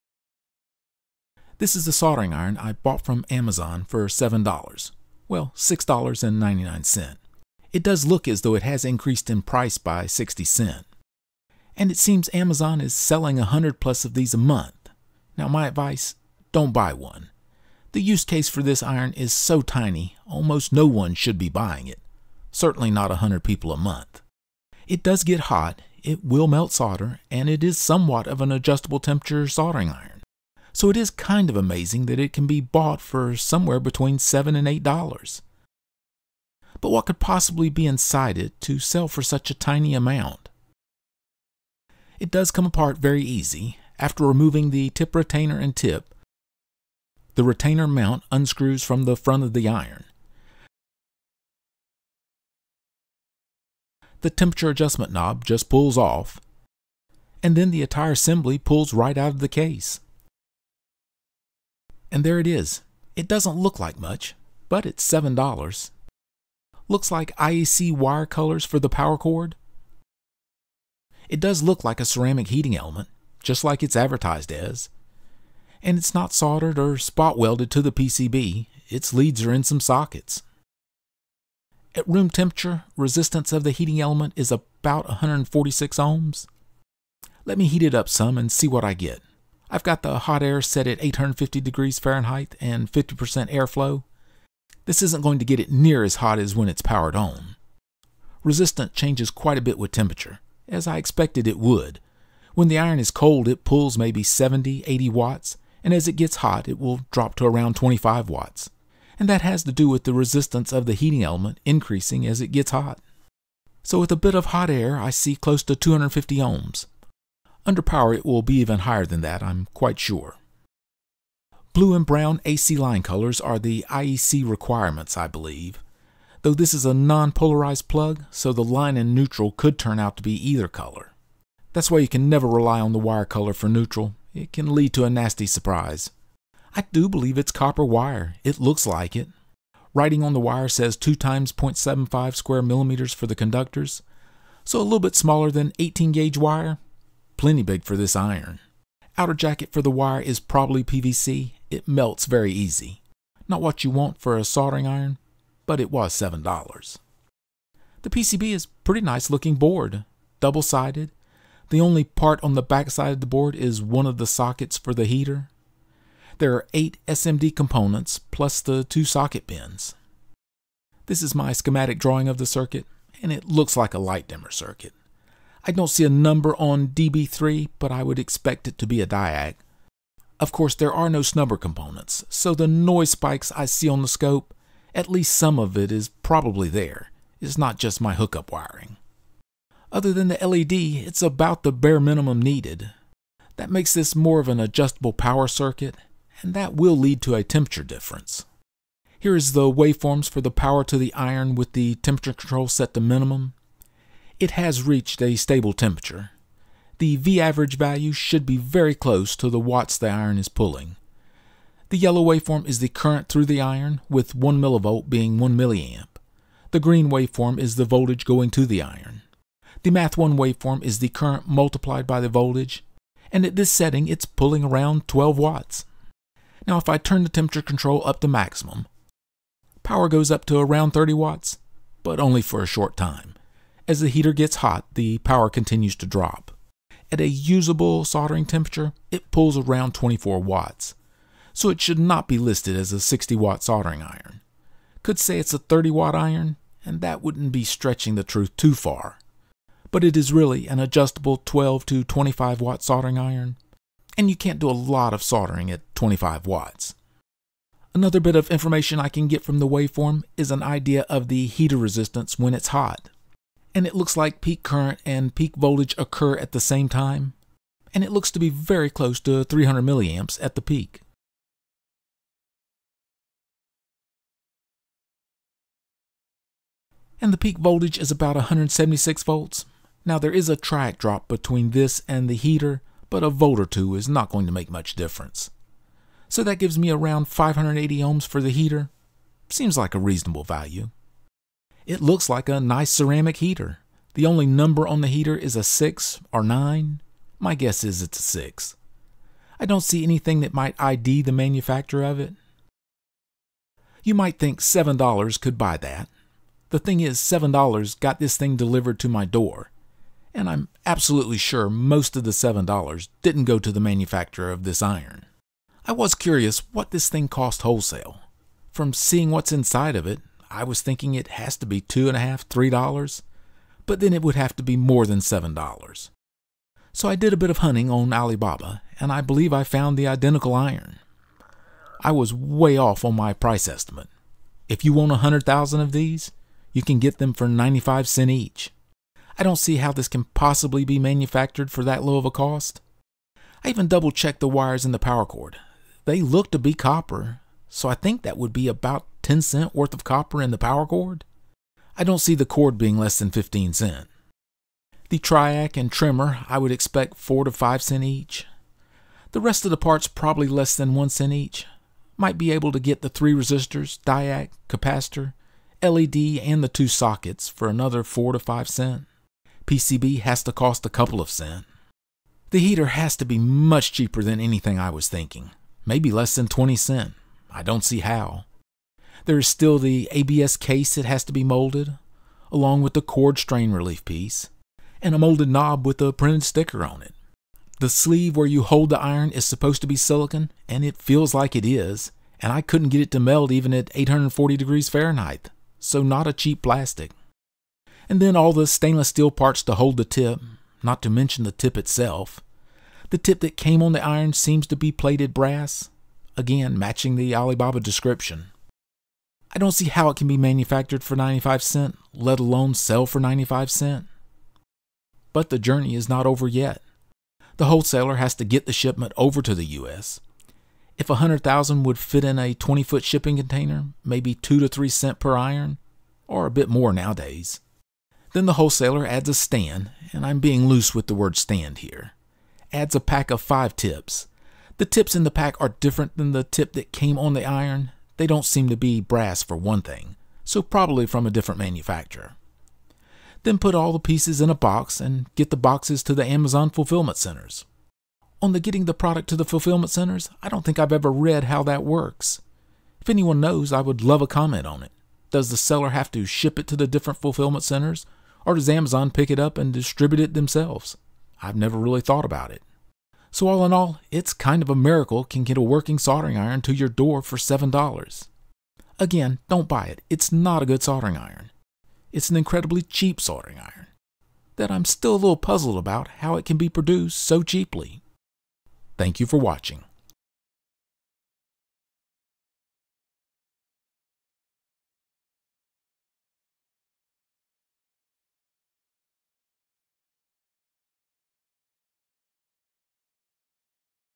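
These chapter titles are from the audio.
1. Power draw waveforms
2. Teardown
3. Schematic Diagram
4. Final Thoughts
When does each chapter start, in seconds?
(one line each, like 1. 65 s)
1. 198 s
2. 35 s
3. 171 s
4. 303 s.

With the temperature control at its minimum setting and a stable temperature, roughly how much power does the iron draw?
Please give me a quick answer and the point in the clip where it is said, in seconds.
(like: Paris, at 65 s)
12 watts, at 225 s.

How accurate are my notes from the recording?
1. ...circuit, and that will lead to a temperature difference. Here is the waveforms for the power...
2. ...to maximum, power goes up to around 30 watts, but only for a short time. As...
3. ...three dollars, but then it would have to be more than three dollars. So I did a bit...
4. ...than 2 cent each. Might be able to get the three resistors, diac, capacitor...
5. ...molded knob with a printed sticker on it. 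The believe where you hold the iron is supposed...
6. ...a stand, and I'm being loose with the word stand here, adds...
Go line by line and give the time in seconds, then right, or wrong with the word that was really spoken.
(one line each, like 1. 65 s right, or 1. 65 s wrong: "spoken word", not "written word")
1. 195 s right
2. 228 s right
3. 322 s wrong: "seven", not "three"
4. 360 s wrong: "1", not "2"
5. 385 s wrong: "sleeve", not "believe"
6. 429 s right.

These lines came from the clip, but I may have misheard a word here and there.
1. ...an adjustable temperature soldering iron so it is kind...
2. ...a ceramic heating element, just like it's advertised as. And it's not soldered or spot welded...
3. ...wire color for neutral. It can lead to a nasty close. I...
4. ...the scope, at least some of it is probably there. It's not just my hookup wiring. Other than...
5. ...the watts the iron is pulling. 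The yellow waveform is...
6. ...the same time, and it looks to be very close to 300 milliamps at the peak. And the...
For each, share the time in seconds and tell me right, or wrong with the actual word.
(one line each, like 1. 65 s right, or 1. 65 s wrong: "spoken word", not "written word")
1. 28 s right
2. 72 s right
3. 132 s wrong: "surprise", not "close"
4. 184 s right
5. 209 s right
6. 266 s right.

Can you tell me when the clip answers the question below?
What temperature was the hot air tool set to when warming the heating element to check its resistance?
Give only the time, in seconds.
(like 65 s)
91 s.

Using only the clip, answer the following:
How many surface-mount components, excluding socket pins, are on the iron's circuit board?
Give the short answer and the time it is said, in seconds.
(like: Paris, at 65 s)
8, at 166 s.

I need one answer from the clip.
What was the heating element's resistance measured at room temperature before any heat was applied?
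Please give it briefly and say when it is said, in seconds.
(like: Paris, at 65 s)
146 ohms, at 85 s.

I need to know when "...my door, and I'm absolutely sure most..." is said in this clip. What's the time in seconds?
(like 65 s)
309 s.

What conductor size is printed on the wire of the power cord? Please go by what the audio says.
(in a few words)
2 x 0.75 square millimeters.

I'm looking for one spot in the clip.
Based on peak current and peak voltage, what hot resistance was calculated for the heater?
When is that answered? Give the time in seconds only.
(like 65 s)
287 s.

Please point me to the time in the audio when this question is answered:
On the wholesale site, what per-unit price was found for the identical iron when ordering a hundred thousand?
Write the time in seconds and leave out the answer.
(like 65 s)
337 s.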